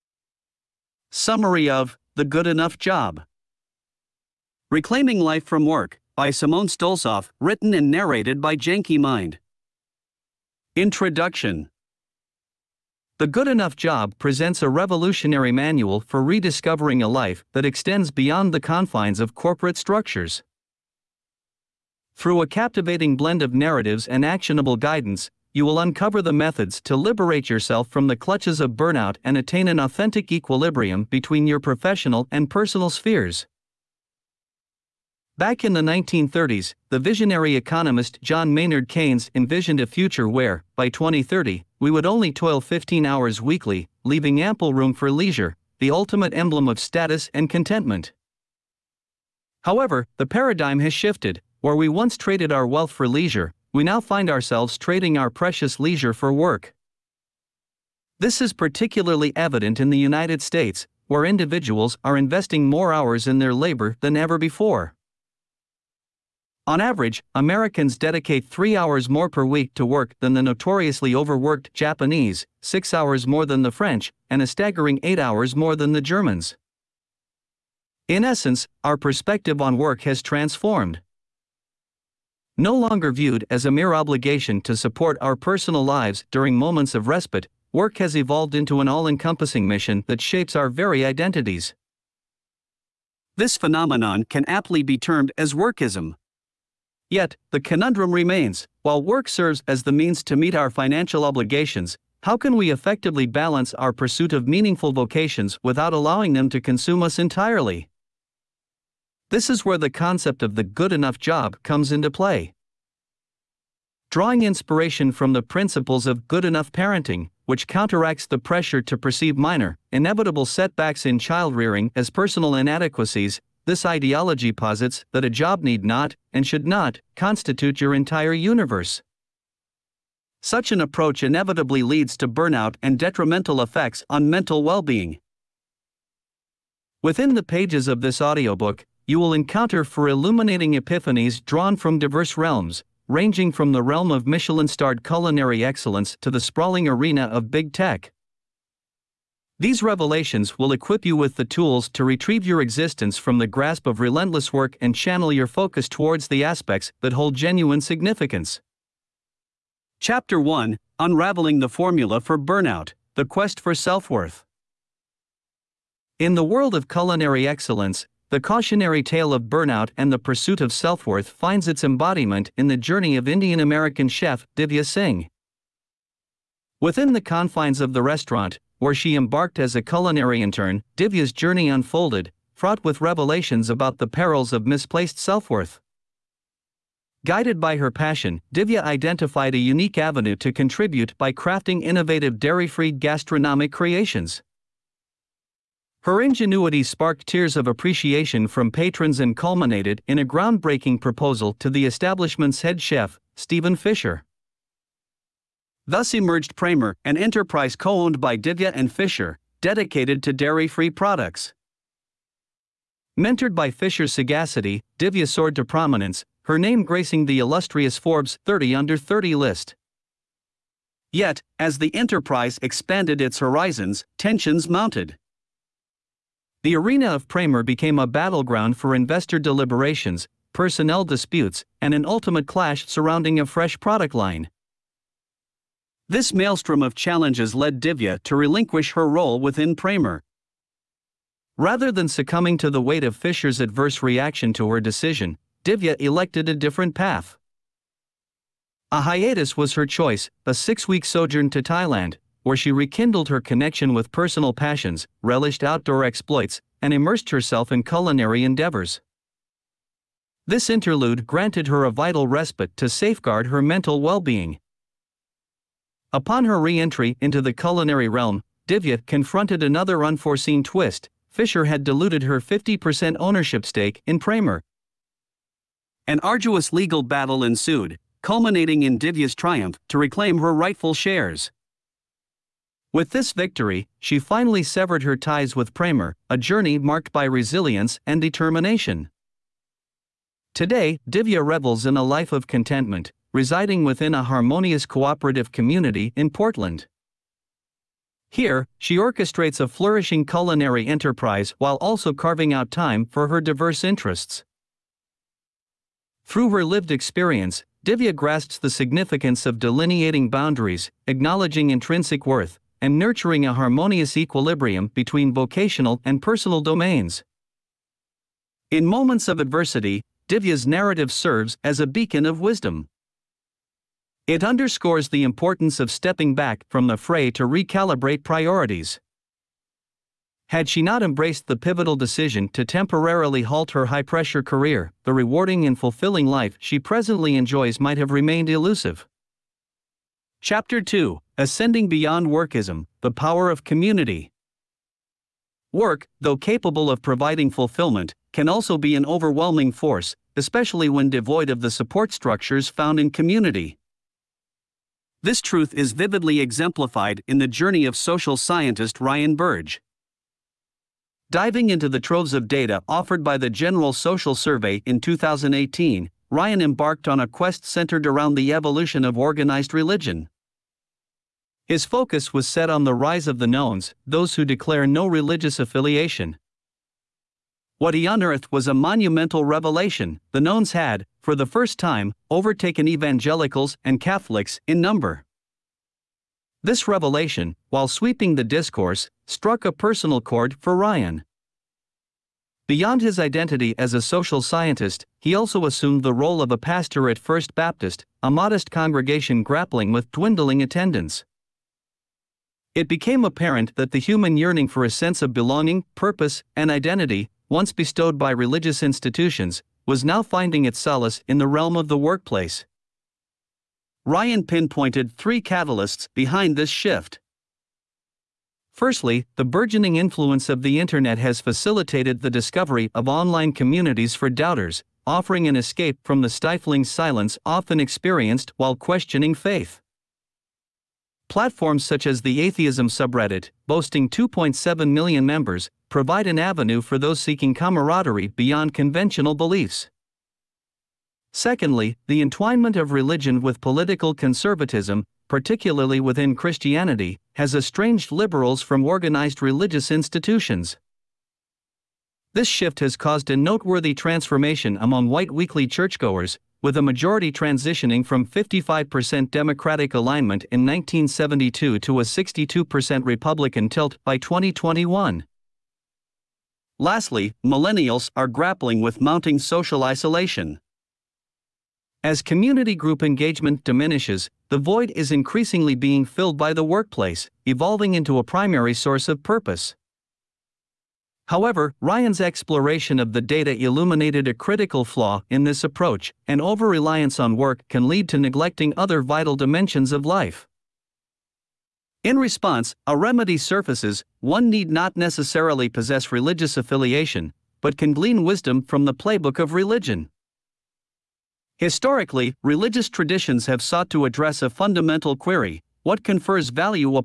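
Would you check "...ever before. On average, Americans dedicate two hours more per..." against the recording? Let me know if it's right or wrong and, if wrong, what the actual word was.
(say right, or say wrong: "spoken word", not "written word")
wrong: "three", not "two".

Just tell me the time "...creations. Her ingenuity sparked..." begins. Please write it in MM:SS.
03:13.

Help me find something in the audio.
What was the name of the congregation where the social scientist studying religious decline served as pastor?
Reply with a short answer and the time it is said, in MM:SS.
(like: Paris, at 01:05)
First Baptist, at 06:37.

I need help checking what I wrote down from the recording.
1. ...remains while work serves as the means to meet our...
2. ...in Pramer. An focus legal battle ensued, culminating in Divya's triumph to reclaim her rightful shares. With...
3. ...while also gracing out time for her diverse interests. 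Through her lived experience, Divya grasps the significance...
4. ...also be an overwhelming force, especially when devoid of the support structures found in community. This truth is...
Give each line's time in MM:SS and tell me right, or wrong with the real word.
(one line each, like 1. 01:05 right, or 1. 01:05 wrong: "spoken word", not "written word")
1. 01:38 right
2. 04:34 wrong: "arduous", not "focus"
3. 05:01 wrong: "carving", not "gracing"
4. 05:48 right.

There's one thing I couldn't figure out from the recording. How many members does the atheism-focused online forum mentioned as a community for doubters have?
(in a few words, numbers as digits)
2.7 million.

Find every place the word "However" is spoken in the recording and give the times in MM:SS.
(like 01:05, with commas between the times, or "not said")
00:49, 08:01.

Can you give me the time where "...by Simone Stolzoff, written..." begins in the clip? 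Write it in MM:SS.
00:06.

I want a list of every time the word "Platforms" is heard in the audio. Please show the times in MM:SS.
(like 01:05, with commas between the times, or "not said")
07:11.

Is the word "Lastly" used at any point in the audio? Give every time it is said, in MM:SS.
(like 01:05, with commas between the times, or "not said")
07:46.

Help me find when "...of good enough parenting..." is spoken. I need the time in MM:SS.
01:56.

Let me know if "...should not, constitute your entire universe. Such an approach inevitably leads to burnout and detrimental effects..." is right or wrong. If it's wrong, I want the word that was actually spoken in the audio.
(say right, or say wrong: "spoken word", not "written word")
right.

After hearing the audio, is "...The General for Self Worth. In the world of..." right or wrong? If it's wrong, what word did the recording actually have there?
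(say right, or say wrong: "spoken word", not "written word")
wrong: "Quest", not "General".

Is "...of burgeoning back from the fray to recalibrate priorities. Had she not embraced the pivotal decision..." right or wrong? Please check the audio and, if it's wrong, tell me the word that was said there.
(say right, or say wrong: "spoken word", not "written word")
wrong: "stepping", not "burgeoning".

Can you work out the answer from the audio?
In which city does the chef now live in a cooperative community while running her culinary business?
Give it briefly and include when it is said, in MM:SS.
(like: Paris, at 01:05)
Portland, at 04:56.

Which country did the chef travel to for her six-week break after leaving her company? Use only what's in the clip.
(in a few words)
Thailand.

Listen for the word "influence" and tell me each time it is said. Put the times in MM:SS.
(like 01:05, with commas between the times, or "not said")
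06:59.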